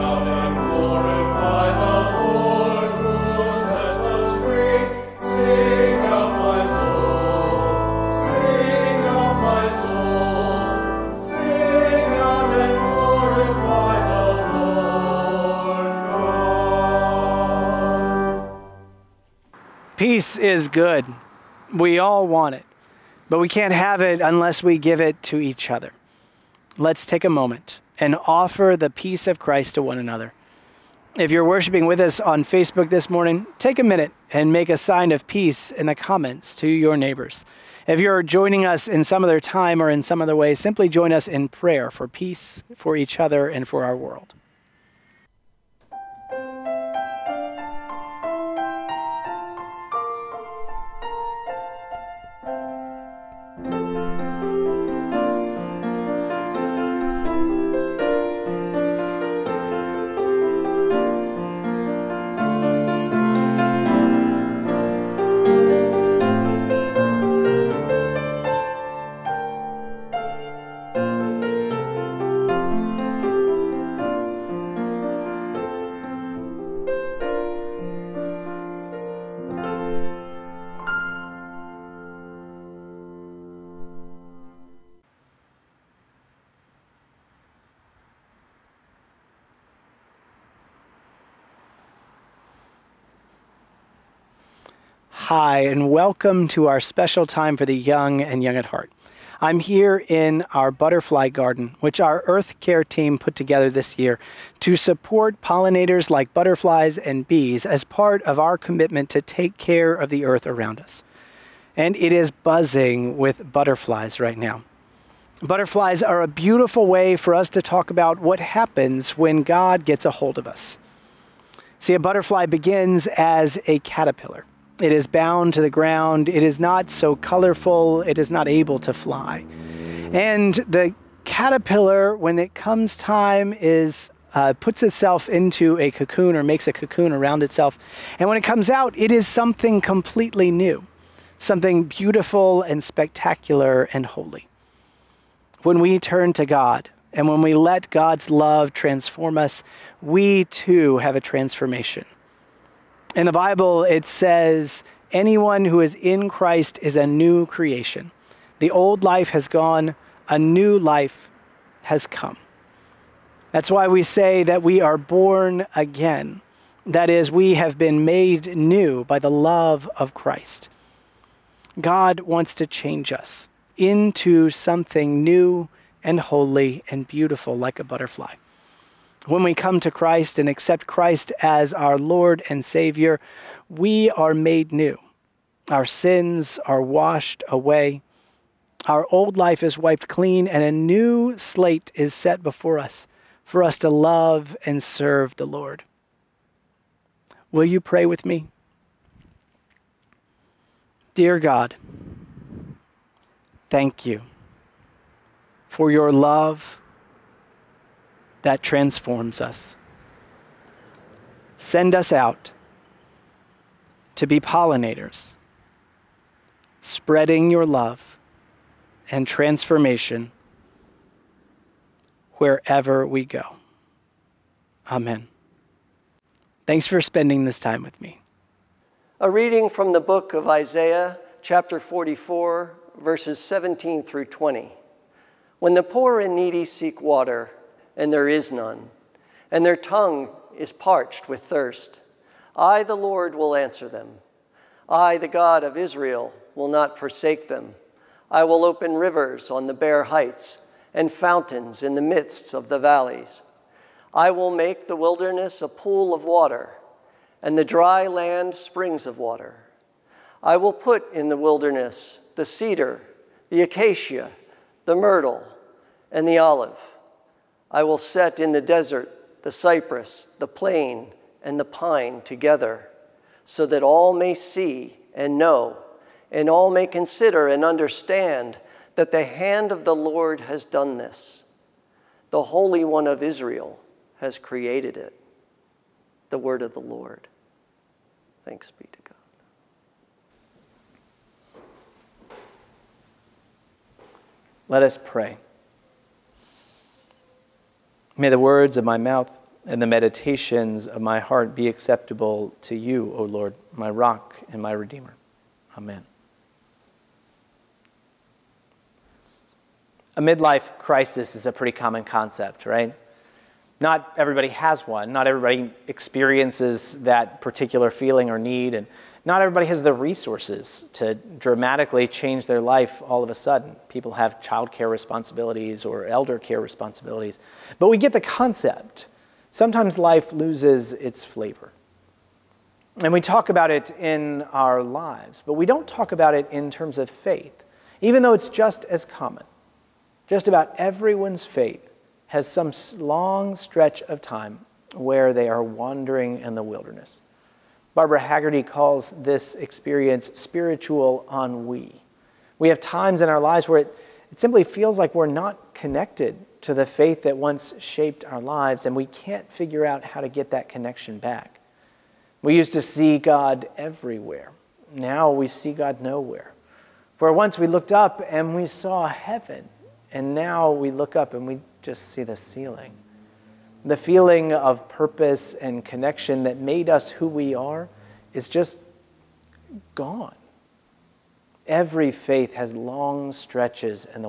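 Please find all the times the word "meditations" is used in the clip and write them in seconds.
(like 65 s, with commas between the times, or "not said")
299 s.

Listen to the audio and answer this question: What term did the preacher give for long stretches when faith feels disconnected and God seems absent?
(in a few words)
Spiritual ennui.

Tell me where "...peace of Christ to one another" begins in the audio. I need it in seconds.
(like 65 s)
28 s.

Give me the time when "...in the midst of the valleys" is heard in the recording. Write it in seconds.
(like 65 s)
251 s.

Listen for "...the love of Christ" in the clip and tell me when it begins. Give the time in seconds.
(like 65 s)
169 s.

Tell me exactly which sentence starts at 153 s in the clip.
In the Bible, it says, Anyone who is in Christ is a new creation.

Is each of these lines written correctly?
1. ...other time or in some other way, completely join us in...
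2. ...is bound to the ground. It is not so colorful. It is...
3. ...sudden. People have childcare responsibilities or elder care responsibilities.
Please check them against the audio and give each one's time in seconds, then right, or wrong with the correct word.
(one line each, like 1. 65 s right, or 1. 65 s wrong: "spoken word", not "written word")
1. 39 s wrong: "simply", not "completely"
2. 124 s right
3. 323 s right.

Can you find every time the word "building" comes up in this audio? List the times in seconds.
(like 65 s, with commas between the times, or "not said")
not said.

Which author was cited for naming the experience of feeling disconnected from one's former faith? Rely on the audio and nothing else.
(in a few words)
Barbara Hagerty.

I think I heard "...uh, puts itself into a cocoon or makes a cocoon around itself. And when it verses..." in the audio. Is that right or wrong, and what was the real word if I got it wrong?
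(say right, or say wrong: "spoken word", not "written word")
wrong: "comes", not "verses".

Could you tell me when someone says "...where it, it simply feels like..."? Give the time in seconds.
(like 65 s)
353 s.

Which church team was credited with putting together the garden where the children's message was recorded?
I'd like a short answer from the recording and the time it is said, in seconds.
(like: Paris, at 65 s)
Earth Care team, at 102 s.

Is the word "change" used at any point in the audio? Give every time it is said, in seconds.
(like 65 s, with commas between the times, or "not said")
172 s, 322 s.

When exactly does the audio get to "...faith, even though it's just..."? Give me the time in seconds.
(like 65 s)
337 s.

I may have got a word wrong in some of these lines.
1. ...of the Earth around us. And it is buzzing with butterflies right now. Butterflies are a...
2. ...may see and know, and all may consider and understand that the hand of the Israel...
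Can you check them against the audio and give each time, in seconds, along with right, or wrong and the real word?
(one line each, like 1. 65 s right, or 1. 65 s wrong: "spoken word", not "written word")
1. 109 s right
2. 274 s wrong: "Lord", not "Israel".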